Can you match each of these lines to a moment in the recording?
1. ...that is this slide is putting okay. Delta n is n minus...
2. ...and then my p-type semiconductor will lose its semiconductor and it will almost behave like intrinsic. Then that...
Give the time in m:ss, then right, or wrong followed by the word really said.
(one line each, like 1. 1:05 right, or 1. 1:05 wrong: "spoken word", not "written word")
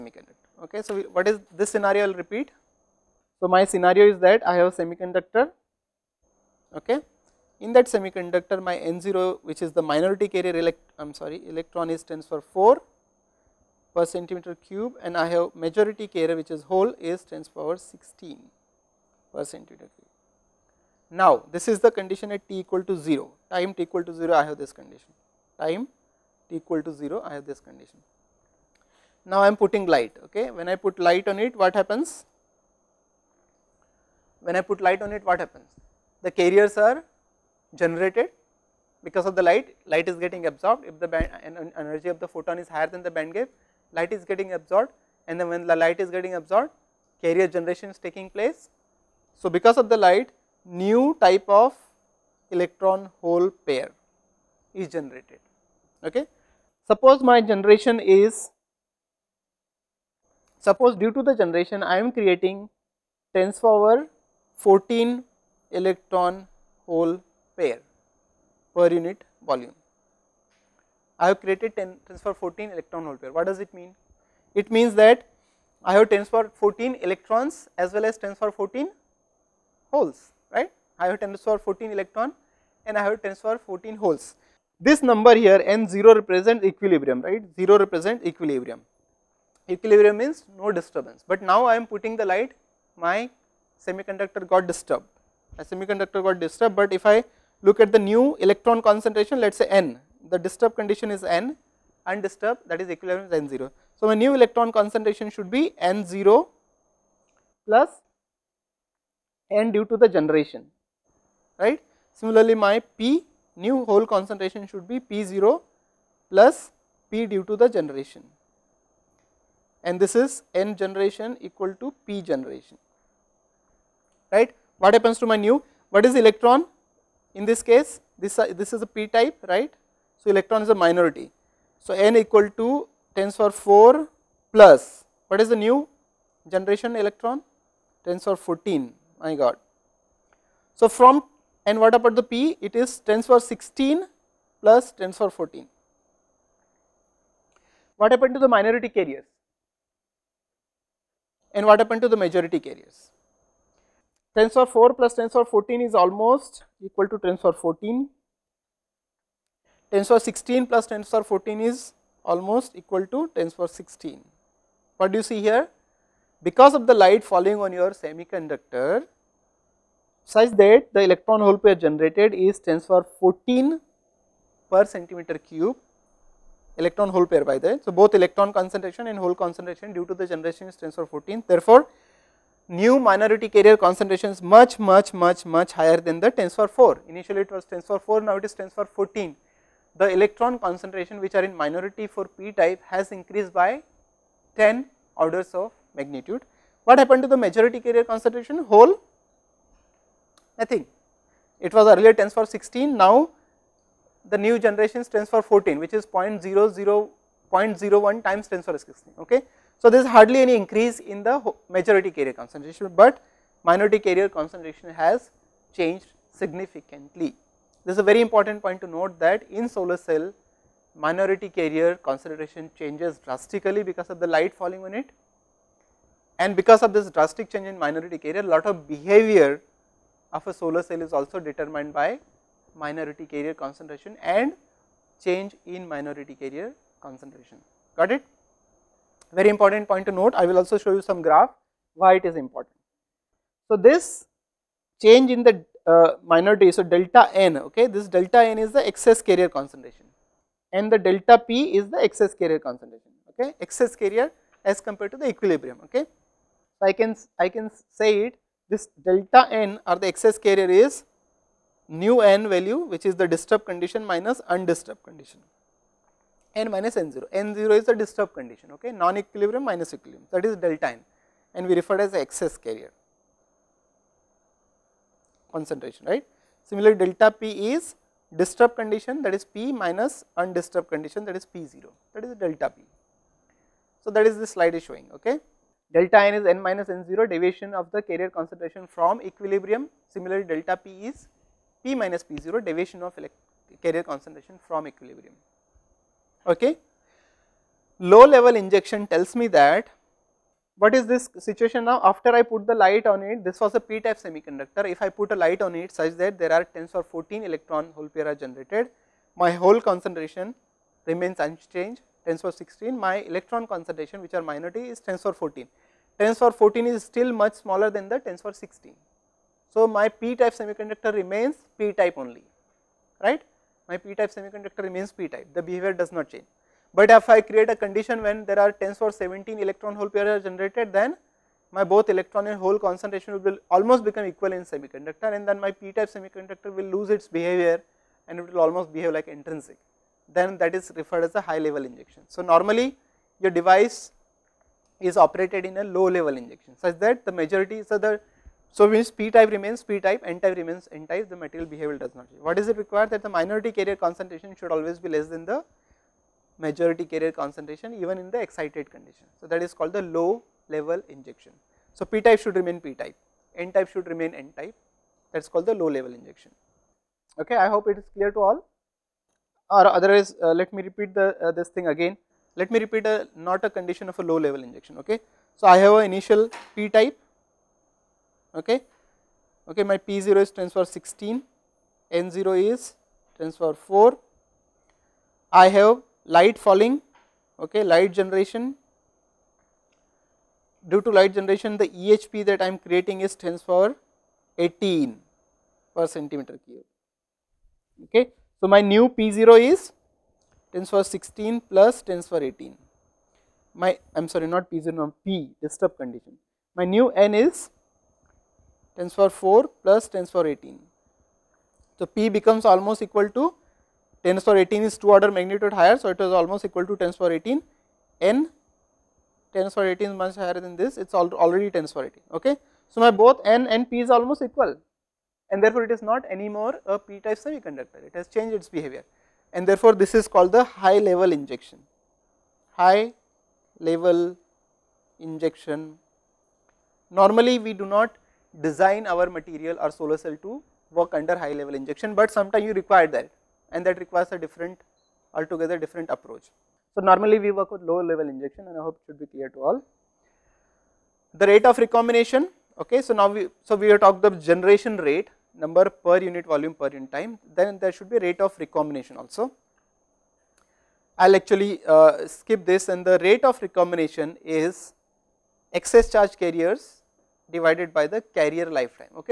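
1. 4:44 wrong: "showing", not "putting"
2. 5:35 wrong: "behavior", not "semiconductor".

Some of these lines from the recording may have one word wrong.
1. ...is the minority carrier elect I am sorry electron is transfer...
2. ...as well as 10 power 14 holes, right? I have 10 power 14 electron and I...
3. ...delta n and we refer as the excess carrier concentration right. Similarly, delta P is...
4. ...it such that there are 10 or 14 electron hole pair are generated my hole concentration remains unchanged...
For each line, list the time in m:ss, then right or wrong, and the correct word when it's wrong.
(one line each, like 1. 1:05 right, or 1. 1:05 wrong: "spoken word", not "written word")
1. 0:09 right
2. 1:17 right
3. 4:30 right
4. 5:05 right.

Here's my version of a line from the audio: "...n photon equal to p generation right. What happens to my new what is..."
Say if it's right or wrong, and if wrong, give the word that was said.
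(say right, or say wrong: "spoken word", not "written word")
wrong: "generation", not "photon".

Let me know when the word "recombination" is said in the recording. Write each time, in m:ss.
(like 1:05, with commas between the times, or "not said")
7:31, 7:38, 7:43.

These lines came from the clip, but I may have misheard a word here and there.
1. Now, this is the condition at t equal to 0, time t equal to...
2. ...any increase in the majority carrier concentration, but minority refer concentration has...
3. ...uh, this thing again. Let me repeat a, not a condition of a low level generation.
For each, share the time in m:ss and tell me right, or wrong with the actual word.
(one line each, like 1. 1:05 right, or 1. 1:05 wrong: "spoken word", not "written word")
1. 0:21 right
2. 3:30 wrong: "carrier", not "refer"
3. 6:11 wrong: "injection", not "generation".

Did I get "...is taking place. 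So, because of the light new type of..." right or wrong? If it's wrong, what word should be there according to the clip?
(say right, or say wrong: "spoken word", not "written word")
right.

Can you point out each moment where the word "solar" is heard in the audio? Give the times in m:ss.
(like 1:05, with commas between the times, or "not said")
3:39, 3:50, 7:19.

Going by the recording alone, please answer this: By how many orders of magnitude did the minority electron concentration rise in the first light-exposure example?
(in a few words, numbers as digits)
10.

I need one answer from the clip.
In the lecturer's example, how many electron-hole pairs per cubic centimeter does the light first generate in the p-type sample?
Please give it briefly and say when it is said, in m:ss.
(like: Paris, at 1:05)
10^14, at 1:03.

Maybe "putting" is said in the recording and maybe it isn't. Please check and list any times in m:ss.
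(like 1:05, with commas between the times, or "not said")
0:29, 1:31.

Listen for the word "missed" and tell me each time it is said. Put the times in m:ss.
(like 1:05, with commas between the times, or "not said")
not said.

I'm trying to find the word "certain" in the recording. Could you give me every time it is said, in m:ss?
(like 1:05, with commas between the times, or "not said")
not said.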